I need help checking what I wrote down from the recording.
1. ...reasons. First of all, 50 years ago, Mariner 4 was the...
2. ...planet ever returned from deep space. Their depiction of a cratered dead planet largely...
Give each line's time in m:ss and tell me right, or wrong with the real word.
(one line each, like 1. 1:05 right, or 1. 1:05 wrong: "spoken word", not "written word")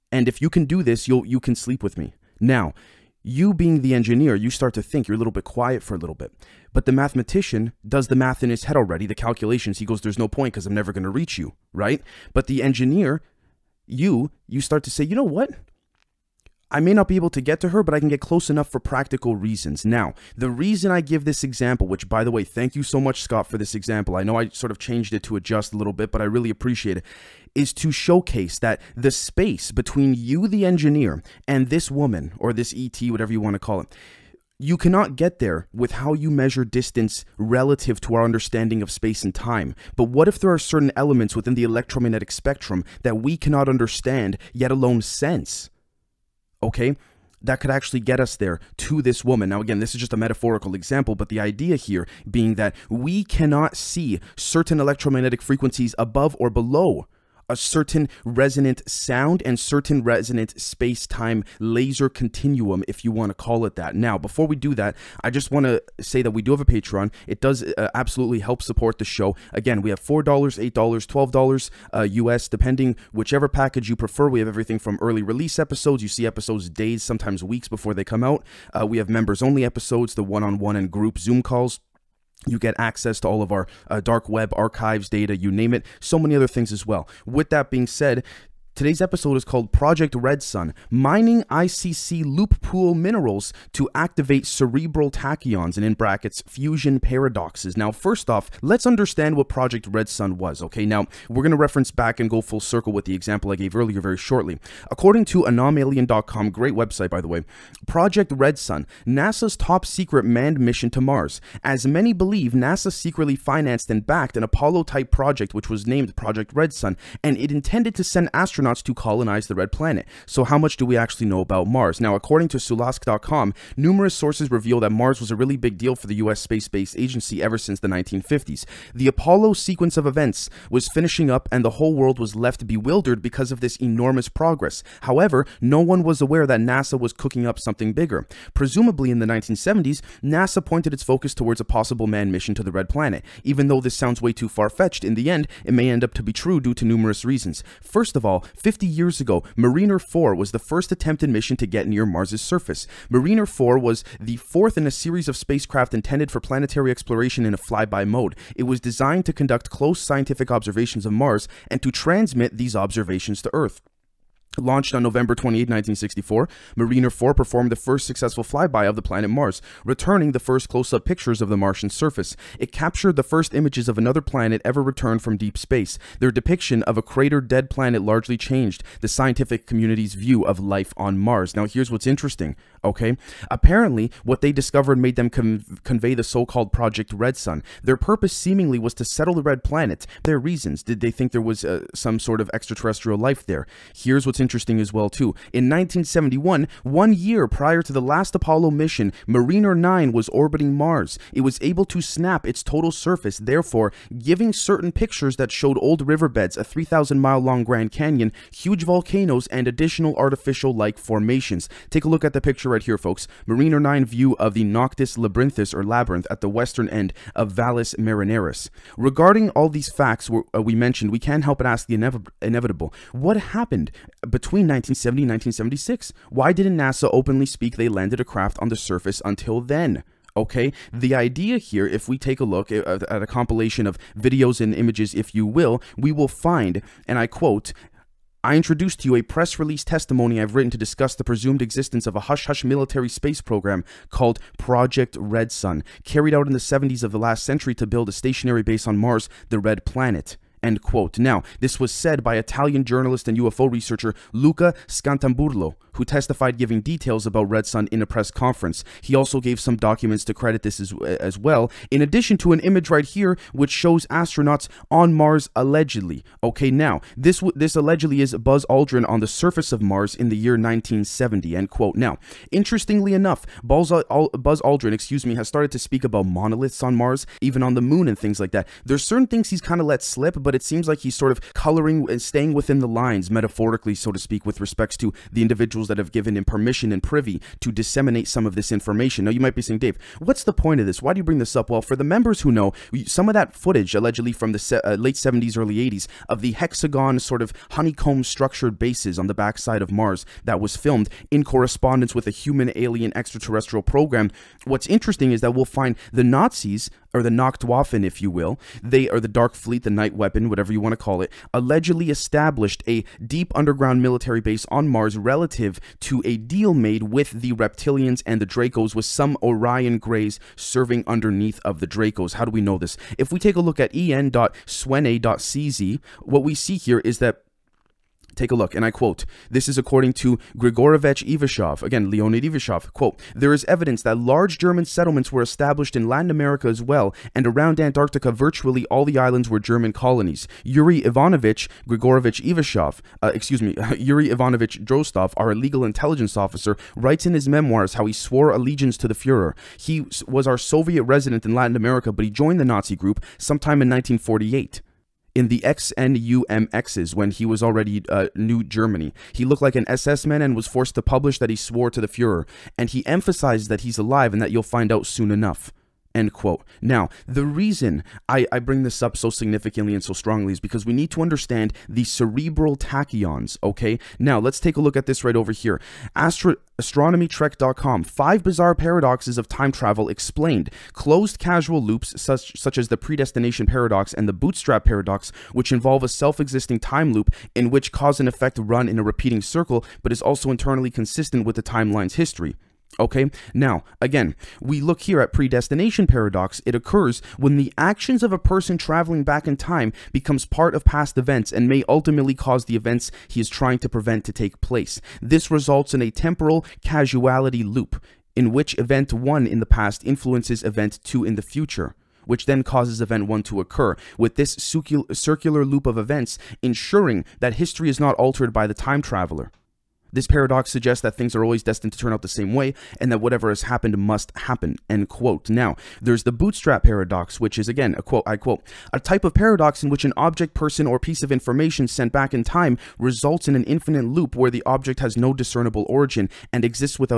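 1. 2:27 right
2. 2:54 right.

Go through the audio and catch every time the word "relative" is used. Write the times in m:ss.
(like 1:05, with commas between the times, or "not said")
0:37, 5:15.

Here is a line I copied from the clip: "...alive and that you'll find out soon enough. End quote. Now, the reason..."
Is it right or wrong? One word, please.
right.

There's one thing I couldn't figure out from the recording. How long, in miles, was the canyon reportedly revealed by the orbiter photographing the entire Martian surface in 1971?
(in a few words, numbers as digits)
3,000.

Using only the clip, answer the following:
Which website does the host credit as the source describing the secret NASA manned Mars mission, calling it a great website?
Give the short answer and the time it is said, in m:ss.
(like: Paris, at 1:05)
anomalien.com, at 1:45.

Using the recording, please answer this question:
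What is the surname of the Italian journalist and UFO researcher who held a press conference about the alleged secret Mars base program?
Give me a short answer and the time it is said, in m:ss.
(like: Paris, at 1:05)
Scantamburlo, at 4:14.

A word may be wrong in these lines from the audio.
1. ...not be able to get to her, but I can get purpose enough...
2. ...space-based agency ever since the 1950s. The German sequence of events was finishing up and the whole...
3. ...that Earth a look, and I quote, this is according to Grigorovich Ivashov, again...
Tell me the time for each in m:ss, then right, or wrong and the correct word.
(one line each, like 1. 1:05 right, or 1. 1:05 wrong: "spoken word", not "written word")
1. 0:16 wrong: "close", not "purpose"
2. 2:06 wrong: "Apollo", not "German"
3. 5:27 wrong: "Take", not "Earth".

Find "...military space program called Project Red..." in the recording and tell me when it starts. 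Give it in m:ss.
4:02.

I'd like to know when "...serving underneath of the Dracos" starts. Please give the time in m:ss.
5:20.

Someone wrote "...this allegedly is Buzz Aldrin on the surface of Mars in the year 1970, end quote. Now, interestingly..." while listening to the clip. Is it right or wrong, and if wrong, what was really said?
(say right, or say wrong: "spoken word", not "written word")
right.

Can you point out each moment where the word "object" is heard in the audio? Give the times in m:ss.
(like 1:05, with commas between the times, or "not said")
7:10, 7:14.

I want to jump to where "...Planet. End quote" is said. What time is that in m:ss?
4:09.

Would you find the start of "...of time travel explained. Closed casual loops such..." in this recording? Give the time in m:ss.
6:19.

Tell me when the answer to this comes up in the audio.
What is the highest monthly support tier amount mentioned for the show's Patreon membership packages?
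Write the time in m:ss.
1:10.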